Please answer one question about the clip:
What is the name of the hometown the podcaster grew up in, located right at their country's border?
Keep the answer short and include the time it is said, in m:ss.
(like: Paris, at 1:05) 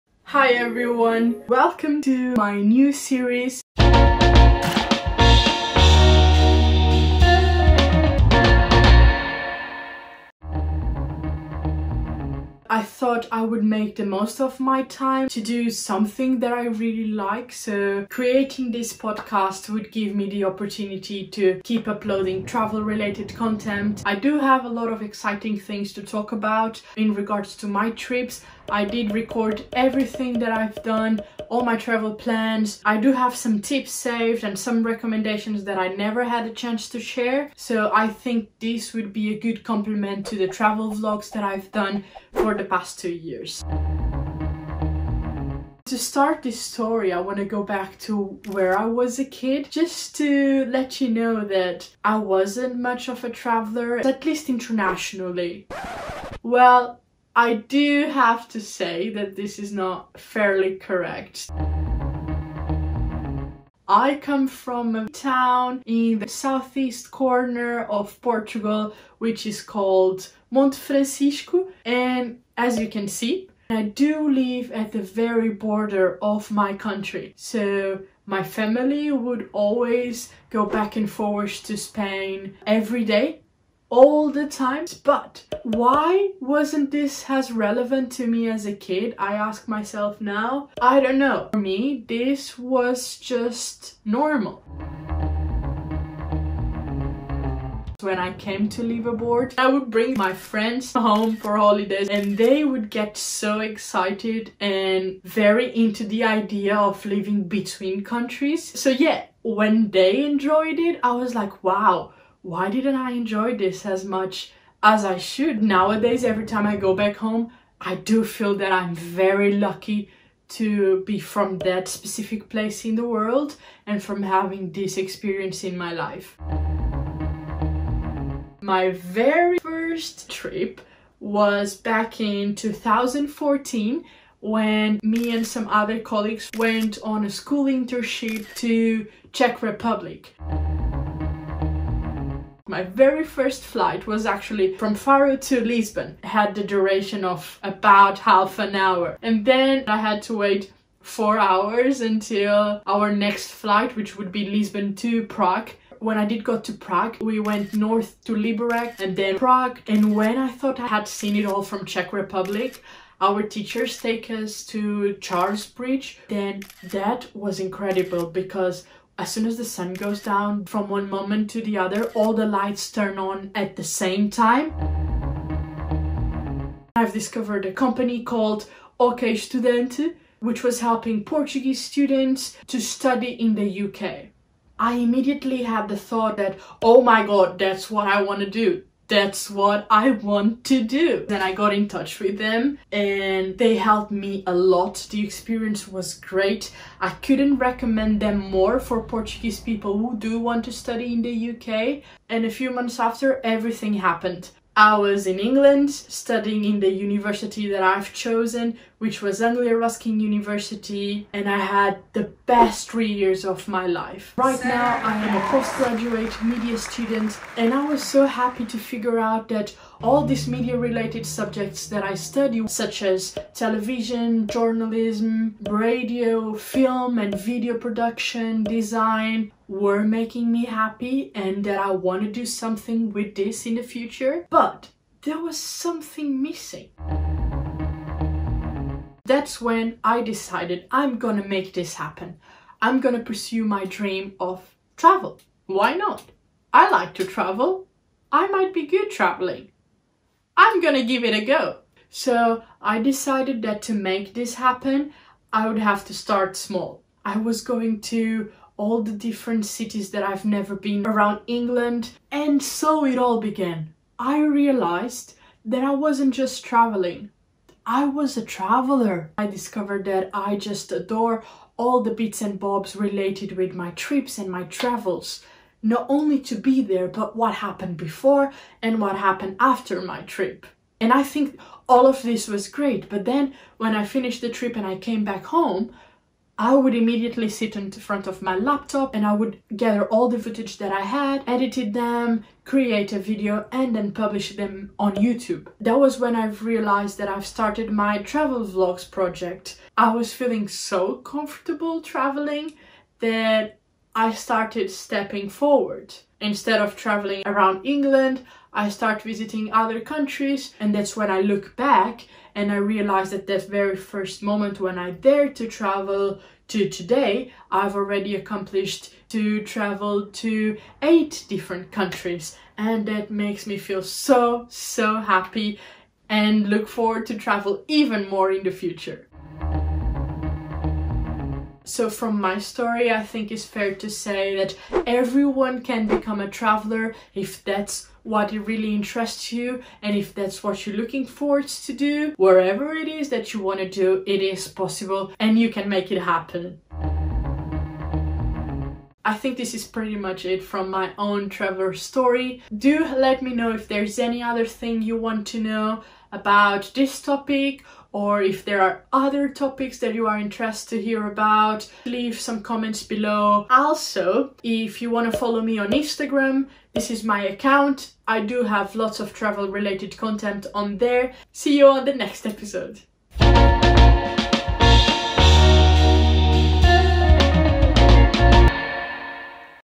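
Monte Francisco, at 1:10.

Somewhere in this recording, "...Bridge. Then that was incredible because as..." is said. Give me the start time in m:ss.
2:45.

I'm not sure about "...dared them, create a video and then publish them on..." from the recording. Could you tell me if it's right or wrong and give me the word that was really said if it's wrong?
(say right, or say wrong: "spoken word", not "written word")
wrong: "edited", not "dared".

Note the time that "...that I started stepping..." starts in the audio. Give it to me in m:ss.
5:03.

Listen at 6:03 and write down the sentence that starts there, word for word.
Also, if you want to follow me on Instagram, this is my account.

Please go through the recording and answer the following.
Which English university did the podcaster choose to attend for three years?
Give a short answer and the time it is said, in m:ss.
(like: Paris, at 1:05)
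Anglia Ruskin University, at 3:29.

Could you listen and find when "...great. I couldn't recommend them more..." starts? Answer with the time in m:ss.
3:16.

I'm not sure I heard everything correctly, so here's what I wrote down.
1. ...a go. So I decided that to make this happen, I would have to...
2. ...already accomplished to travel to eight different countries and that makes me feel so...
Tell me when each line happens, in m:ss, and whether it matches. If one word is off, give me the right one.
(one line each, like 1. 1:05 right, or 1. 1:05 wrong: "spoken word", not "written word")
1. 4:11 right
2. 5:17 right.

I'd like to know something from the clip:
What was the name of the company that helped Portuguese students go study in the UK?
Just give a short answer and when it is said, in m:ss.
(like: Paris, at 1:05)
OkEstudante, at 2:58.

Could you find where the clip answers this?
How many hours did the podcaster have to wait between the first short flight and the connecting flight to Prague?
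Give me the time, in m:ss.
2:31.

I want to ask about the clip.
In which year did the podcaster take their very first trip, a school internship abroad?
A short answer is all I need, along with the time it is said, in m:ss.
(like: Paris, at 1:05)
2014, at 2:12.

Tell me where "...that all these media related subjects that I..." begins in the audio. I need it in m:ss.
3:39.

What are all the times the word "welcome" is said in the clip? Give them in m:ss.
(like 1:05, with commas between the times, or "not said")
0:01.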